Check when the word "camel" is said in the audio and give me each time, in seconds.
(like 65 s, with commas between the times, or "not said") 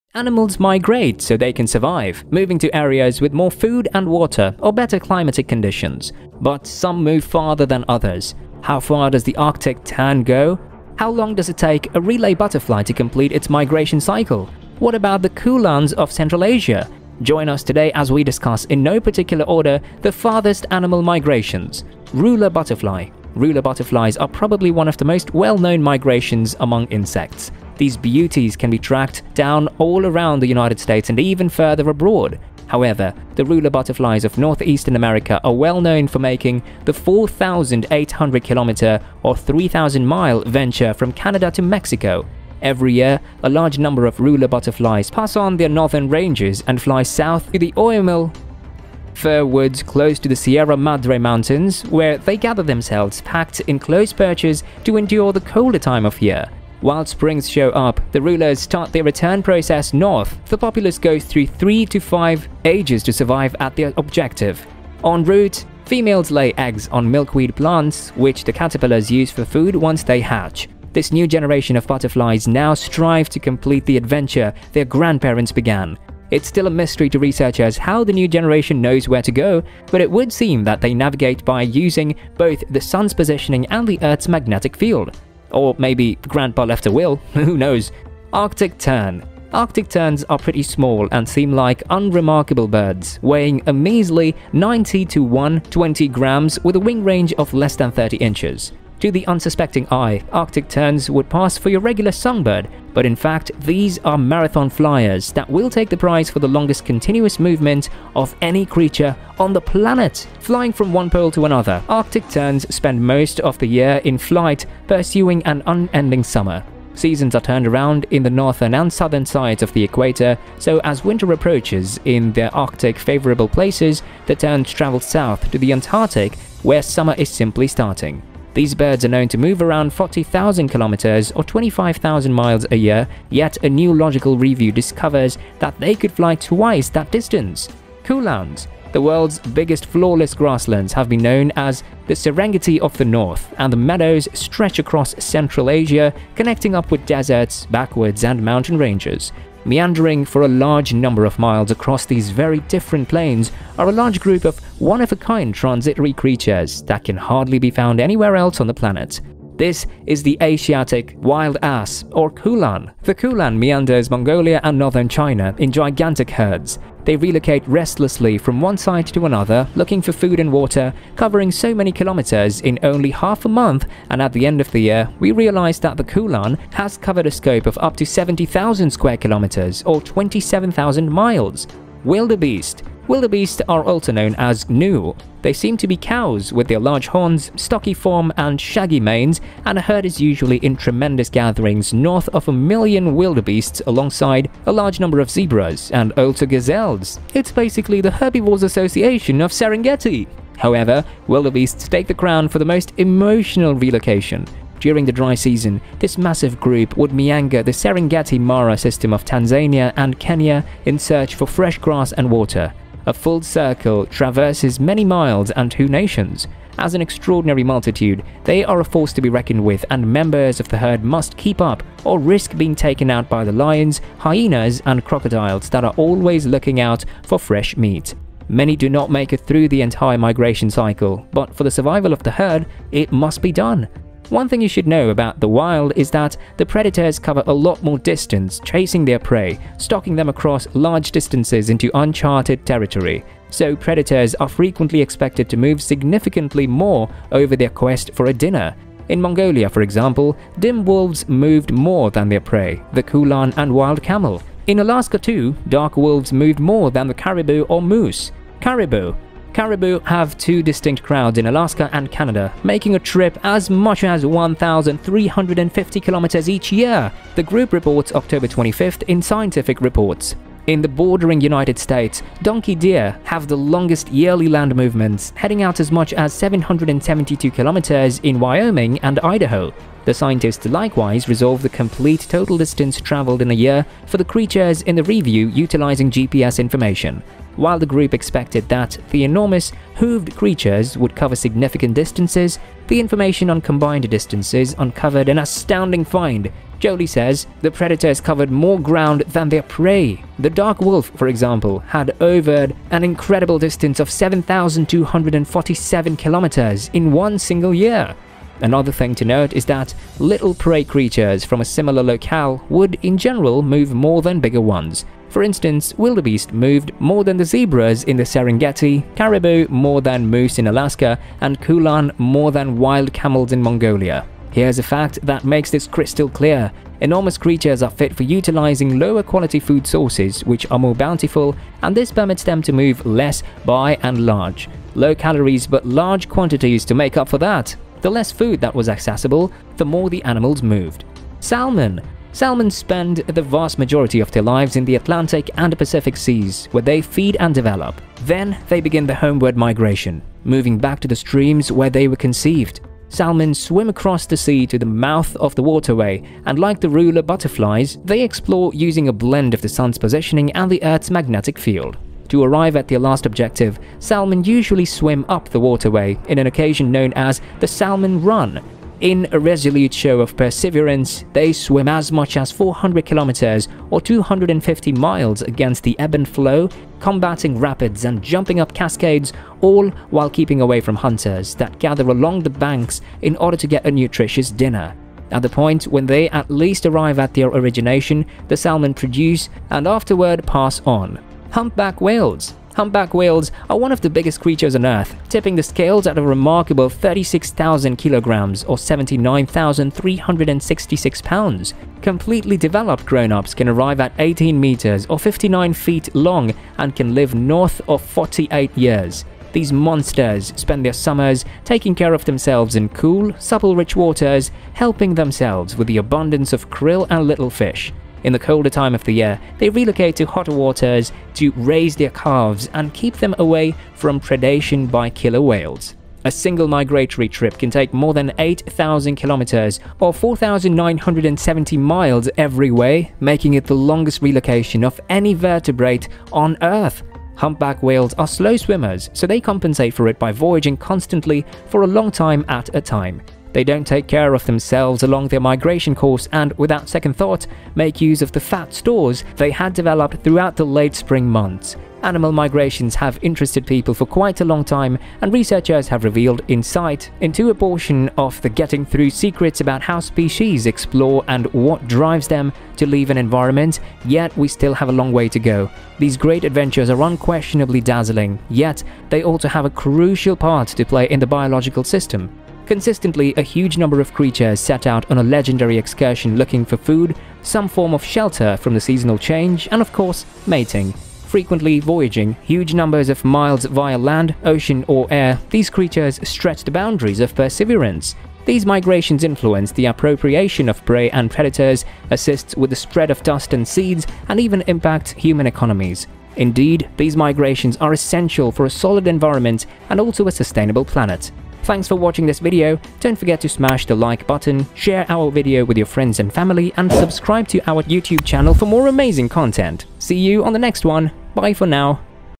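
254 s, 323 s.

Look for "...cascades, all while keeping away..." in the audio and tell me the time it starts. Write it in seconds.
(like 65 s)
378 s.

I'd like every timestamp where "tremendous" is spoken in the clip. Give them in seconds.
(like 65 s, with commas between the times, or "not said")
190 s.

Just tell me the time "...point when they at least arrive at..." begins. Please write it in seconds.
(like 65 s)
385 s.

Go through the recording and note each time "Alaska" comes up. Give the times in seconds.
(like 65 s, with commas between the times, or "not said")
254 s, 261 s, 320 s.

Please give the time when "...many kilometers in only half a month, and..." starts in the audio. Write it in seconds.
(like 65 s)
171 s.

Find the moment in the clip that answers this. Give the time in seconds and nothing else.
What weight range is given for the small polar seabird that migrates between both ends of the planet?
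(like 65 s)
94 s.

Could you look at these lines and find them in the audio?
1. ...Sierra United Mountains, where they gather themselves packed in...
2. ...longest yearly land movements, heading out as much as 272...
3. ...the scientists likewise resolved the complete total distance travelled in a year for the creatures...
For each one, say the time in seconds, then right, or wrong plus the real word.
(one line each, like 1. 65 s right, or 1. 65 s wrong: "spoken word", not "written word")
1. 50 s wrong: "Madre", not "United"
2. 273 s wrong: "772", not "272"
3. 280 s right.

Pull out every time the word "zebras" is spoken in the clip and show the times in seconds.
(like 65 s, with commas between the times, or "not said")
195 s, 317 s.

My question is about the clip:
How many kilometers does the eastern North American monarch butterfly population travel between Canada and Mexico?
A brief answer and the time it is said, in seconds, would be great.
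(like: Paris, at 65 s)
4,800, at 36 s.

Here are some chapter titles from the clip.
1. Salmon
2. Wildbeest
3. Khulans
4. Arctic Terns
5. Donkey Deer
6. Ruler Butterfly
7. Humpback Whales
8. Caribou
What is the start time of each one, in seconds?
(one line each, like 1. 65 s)
1. 342 s
2. 182 s
3. 138 s
4. 87 s
5. 273 s
6. 23 s
7. 392 s
8. 259 s.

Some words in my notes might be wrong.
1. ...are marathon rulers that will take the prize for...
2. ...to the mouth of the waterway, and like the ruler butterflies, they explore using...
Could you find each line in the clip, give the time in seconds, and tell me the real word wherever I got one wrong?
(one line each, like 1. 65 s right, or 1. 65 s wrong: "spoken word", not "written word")
1. 104 s wrong: "flyers", not "rulers"
2. 354 s right.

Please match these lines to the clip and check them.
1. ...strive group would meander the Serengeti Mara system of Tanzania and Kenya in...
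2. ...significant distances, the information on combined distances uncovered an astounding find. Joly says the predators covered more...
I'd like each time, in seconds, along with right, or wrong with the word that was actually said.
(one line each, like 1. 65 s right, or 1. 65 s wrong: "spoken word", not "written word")
1. 206 s wrong: "massive", not "strive"
2. 291 s right.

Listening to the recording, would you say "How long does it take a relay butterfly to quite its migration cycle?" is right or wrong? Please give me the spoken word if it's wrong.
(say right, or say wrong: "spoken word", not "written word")
wrong: "complete", not "quite".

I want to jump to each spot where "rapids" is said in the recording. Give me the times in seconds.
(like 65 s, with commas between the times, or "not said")
377 s.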